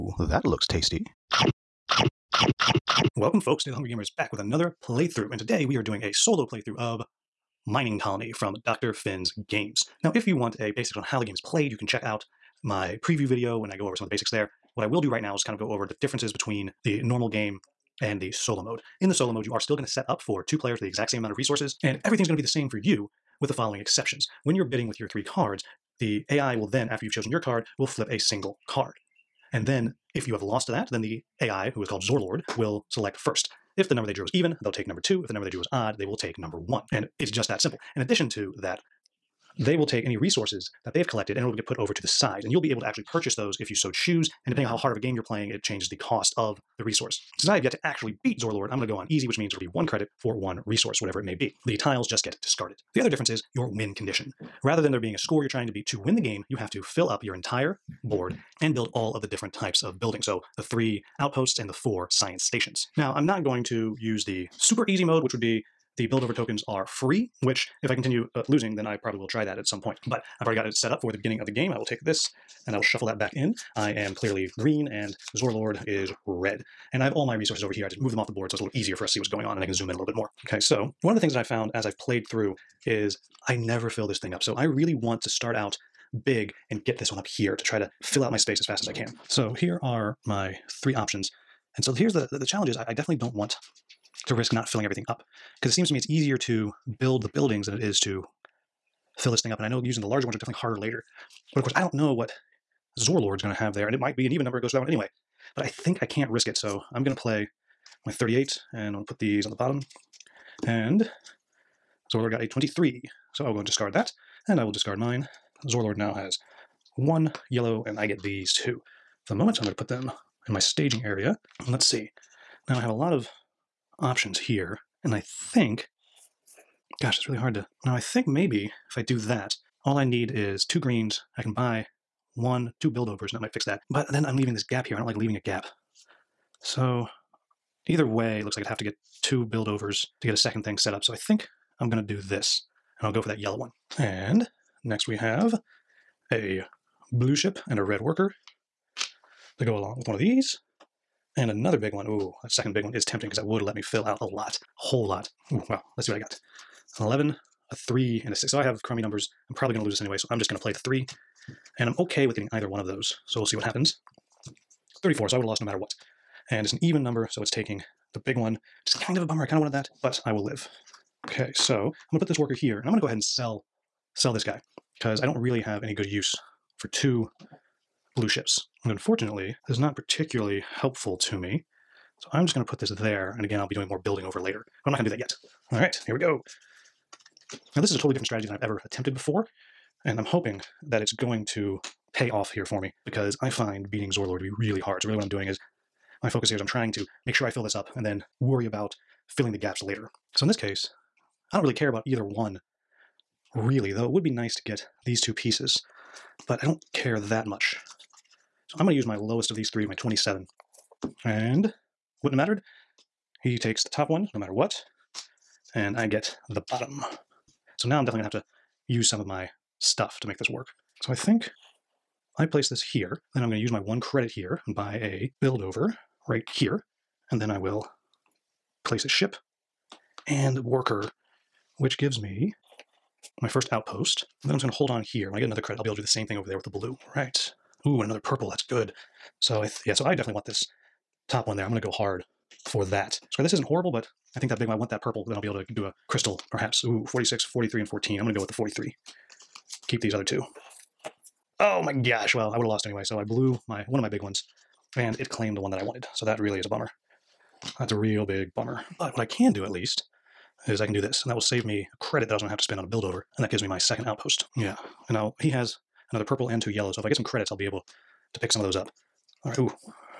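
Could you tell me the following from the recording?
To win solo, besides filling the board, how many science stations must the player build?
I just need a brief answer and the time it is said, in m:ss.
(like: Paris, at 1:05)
4, at 1:01.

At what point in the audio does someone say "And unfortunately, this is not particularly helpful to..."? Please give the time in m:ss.
2:58.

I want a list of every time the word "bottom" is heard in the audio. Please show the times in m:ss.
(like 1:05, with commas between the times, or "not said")
1:49, 3:36.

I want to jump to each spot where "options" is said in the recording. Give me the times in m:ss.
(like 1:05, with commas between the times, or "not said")
1:30, 2:04.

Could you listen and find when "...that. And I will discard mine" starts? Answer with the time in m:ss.
1:53.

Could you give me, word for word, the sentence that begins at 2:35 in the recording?
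Ooh, well, let's see what I got.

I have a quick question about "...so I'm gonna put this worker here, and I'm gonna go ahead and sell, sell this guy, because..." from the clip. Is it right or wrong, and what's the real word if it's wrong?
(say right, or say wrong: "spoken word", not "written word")
right.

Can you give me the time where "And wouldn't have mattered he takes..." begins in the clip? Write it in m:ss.
3:31.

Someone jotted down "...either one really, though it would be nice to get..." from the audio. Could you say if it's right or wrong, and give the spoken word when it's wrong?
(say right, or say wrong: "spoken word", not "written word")
right.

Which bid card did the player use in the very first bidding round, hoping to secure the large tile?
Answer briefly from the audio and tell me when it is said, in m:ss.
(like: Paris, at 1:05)
38, at 1:48.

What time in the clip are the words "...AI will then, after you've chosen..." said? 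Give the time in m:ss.
0:26.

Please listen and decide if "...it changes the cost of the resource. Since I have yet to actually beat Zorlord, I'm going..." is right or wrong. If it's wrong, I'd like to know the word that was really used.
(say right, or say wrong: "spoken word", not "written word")
right.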